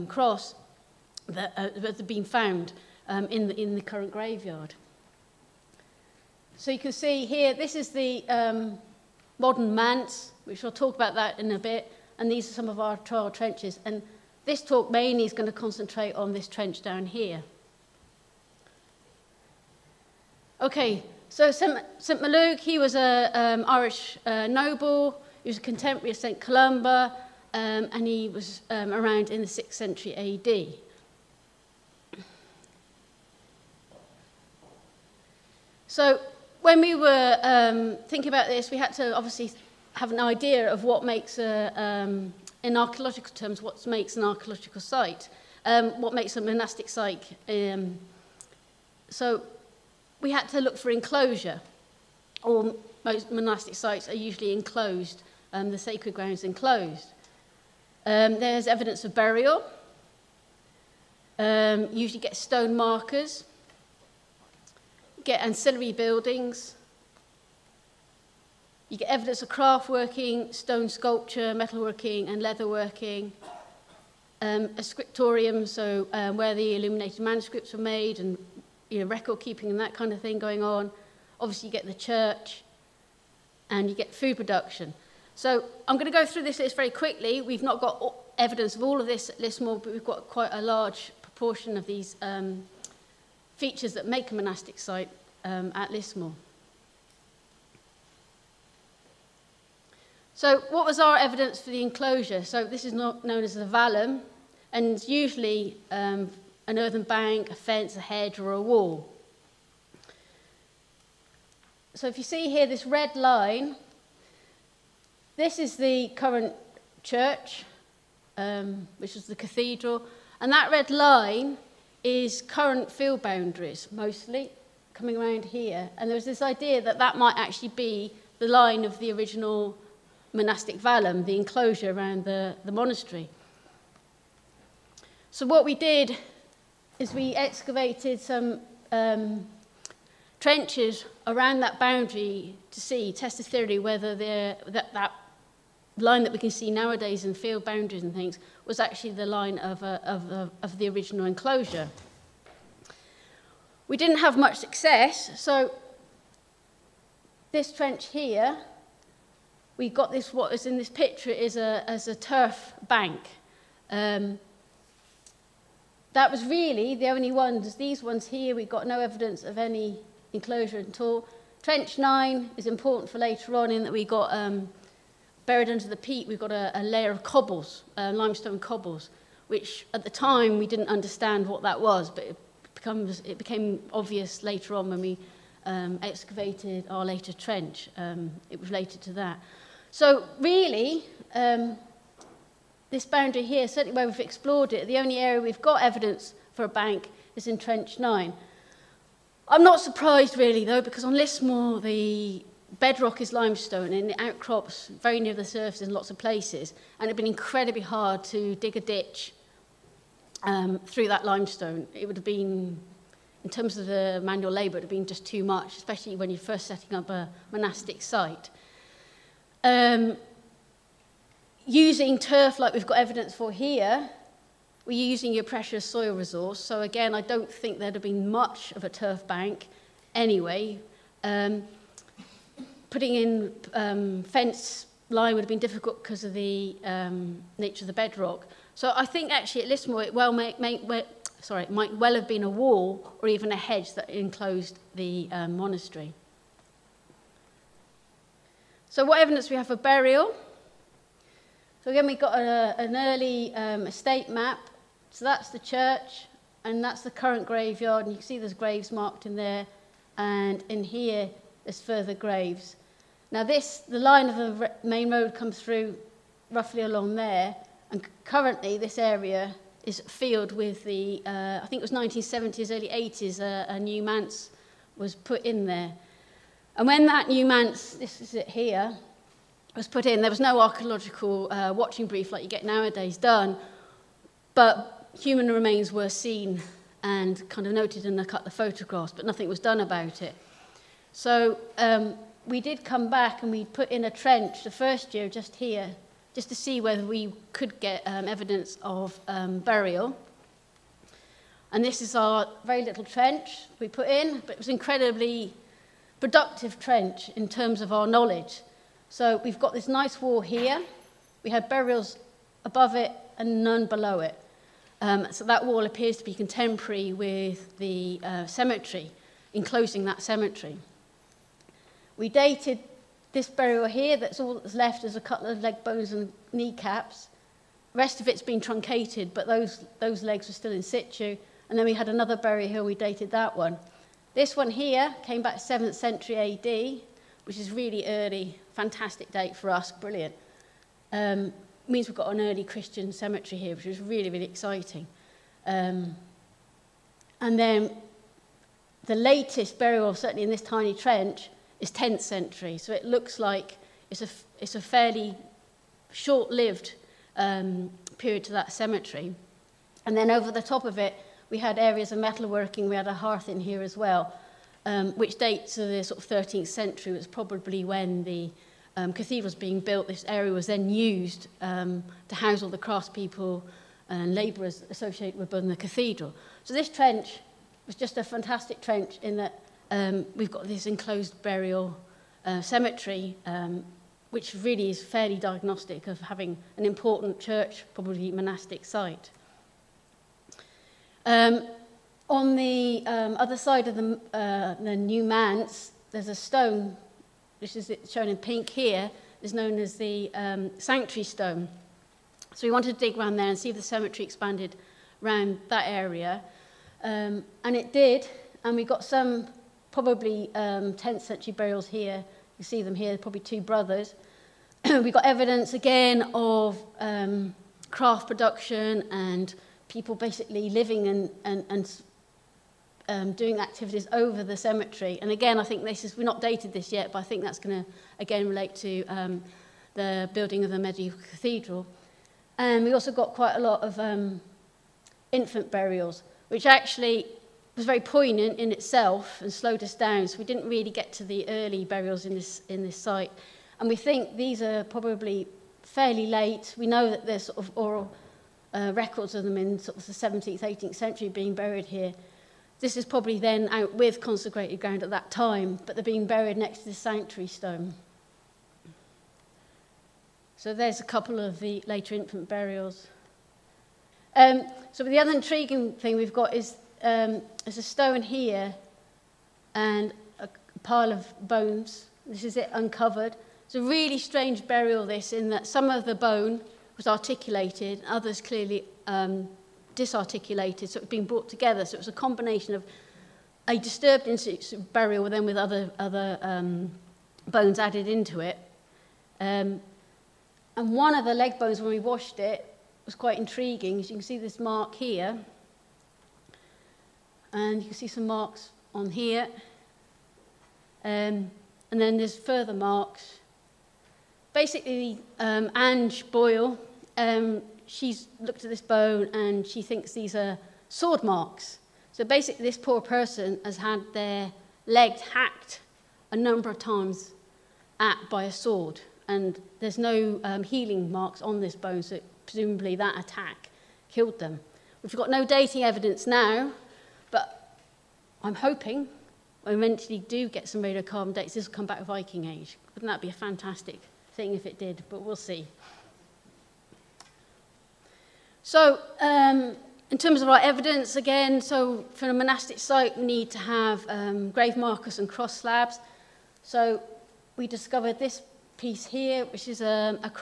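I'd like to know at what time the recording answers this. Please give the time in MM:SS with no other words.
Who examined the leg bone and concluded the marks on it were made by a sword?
08:25.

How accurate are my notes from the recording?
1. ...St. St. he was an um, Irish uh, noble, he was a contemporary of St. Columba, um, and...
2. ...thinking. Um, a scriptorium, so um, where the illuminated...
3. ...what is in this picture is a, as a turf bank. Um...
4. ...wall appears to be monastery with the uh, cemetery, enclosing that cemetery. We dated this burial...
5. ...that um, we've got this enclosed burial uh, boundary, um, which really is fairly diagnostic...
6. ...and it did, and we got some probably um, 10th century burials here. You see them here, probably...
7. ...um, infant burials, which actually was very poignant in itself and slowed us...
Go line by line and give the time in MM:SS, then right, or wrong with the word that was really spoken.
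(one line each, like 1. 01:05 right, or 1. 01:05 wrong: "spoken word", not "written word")
1. 00:21 right
2. 01:12 wrong: "leatherworking", not "thinking"
3. 02:40 right
4. 05:15 wrong: "contemporary", not "monastery"
5. 06:19 wrong: "cemetery", not "boundary"
6. 06:47 right
7. 07:13 right.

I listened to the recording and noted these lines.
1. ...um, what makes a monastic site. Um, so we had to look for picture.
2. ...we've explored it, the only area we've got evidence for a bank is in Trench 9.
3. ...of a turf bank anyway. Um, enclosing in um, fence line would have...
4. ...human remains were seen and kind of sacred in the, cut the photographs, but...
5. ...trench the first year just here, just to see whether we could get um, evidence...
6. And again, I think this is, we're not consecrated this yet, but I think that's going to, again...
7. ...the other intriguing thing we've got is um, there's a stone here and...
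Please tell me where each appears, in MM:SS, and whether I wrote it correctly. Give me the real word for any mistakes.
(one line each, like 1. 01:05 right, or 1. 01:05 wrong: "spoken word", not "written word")
1. 00:45 wrong: "enclosure", not "picture"
2. 03:14 right
3. 03:48 wrong: "putting", not "enclosing"
4. 04:45 wrong: "noted", not "sacred"
5. 04:54 right
6. 07:05 wrong: "dated", not "consecrated"
7. 07:45 right.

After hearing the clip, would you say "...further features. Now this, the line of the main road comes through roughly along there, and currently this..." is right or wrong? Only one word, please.
wrong.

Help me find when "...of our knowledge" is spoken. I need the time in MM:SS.
05:07.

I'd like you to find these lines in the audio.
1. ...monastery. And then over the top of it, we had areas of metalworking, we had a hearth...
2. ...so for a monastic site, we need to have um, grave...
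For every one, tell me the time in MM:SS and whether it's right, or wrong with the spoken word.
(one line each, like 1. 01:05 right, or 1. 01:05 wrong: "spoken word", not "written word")
1. 05:58 wrong: "cemetery", not "monastery"
2. 09:01 right.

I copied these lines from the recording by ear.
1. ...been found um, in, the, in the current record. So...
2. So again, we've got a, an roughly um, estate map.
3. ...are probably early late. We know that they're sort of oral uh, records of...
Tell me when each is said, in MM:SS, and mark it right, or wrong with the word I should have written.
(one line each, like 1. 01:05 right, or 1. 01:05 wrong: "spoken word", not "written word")
1. 00:02 wrong: "graveyard", not "record"
2. 04:11 wrong: "early", not "roughly"
3. 07:24 wrong: "fairly", not "early".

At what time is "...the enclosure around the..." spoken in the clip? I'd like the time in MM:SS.
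02:11.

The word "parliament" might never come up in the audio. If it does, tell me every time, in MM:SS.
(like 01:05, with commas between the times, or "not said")
not said.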